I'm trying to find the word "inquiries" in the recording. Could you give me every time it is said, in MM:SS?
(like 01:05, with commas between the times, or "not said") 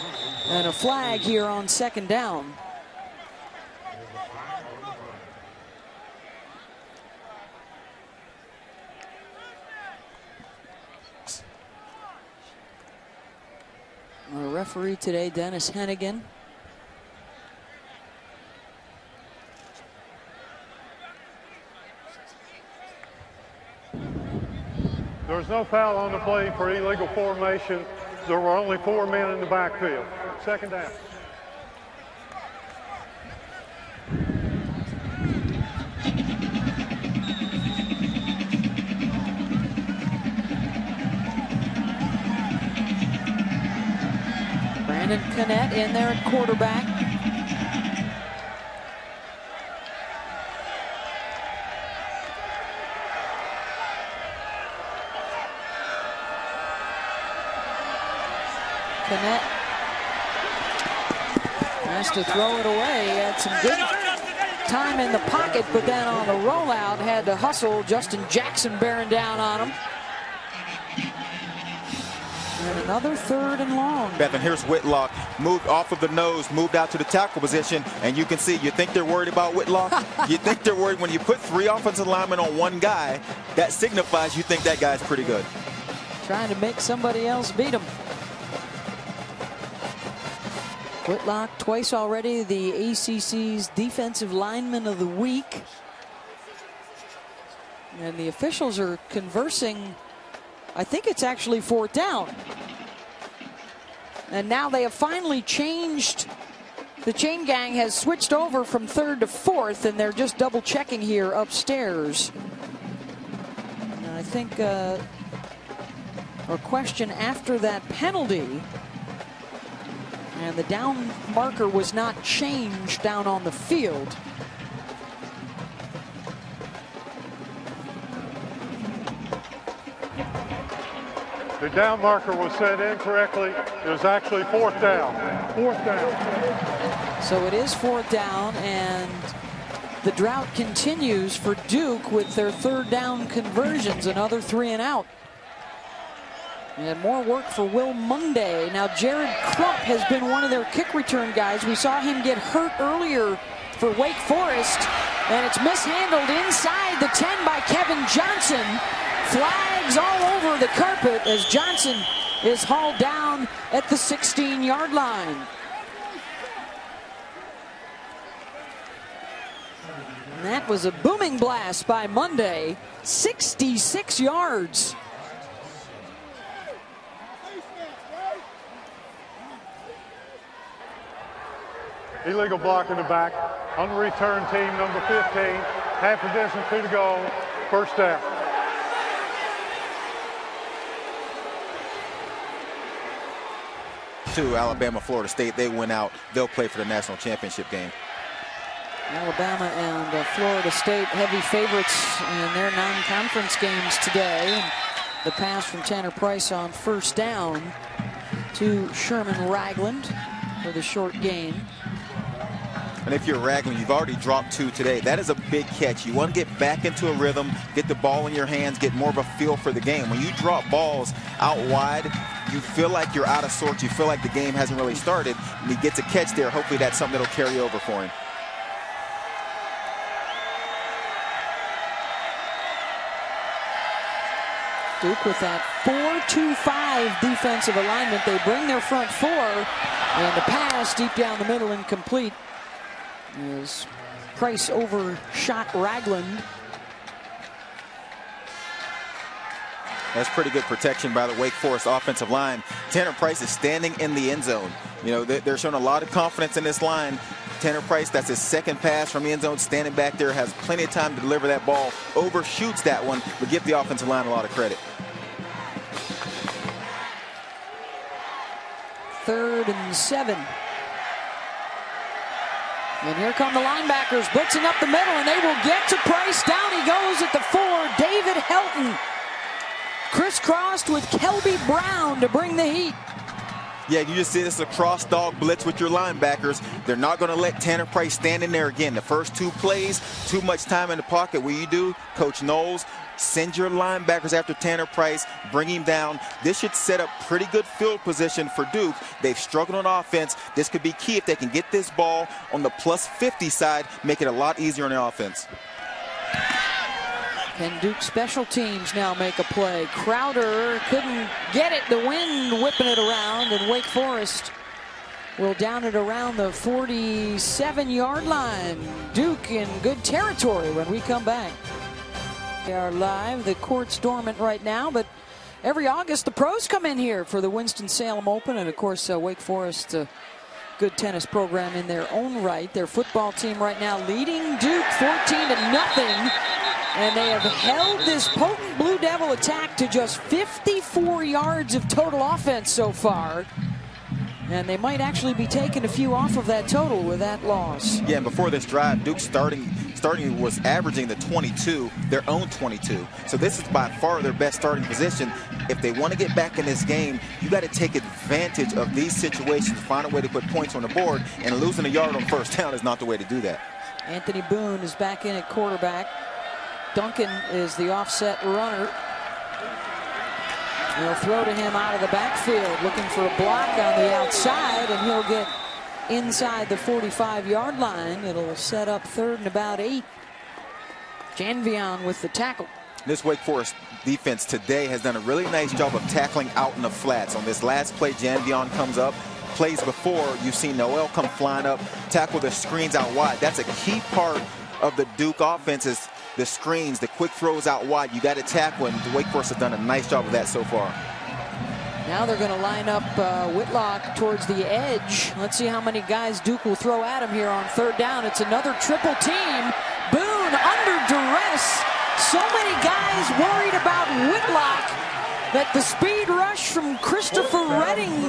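not said.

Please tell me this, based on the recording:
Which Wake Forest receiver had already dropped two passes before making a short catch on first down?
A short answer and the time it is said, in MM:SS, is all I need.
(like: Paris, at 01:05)
Sherman Ragland, at 03:28.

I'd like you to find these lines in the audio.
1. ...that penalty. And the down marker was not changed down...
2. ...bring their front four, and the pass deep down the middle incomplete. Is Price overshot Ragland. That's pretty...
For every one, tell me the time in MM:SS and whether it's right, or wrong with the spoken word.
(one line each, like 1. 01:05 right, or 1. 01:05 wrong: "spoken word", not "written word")
1. 01:57 right
2. 03:58 right.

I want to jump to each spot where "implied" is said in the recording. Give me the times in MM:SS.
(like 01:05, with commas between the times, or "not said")
not said.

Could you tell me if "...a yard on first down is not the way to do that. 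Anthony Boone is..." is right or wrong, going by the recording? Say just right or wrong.
right.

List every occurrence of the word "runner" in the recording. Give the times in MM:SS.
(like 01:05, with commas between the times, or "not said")
06:08.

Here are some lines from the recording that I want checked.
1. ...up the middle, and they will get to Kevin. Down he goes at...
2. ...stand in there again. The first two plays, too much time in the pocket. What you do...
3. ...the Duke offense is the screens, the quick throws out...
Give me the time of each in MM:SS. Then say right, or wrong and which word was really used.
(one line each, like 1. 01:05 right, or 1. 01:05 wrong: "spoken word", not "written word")
1. 04:34 wrong: "Price", not "Kevin"
2. 04:48 right
3. 06:34 right.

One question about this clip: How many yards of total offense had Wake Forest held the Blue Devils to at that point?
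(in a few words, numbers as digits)
54.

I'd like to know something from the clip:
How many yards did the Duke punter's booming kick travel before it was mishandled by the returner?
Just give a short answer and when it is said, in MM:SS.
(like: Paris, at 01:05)
66 yards, at 02:53.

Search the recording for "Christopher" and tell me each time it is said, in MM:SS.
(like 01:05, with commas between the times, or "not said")
06:56.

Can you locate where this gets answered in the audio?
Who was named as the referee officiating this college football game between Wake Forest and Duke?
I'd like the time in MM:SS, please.
00:15.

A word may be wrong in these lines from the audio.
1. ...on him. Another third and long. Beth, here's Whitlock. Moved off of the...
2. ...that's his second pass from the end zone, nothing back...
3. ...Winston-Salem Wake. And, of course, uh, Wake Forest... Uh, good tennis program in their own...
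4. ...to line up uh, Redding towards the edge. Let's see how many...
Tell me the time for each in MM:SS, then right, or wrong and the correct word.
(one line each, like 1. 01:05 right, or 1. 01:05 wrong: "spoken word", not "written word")
1. 01:09 right
2. 04:18 wrong: "standing", not "nothing"
3. 05:27 wrong: "Open", not "Wake"
4. 06:42 wrong: "Whitlock", not "Redding".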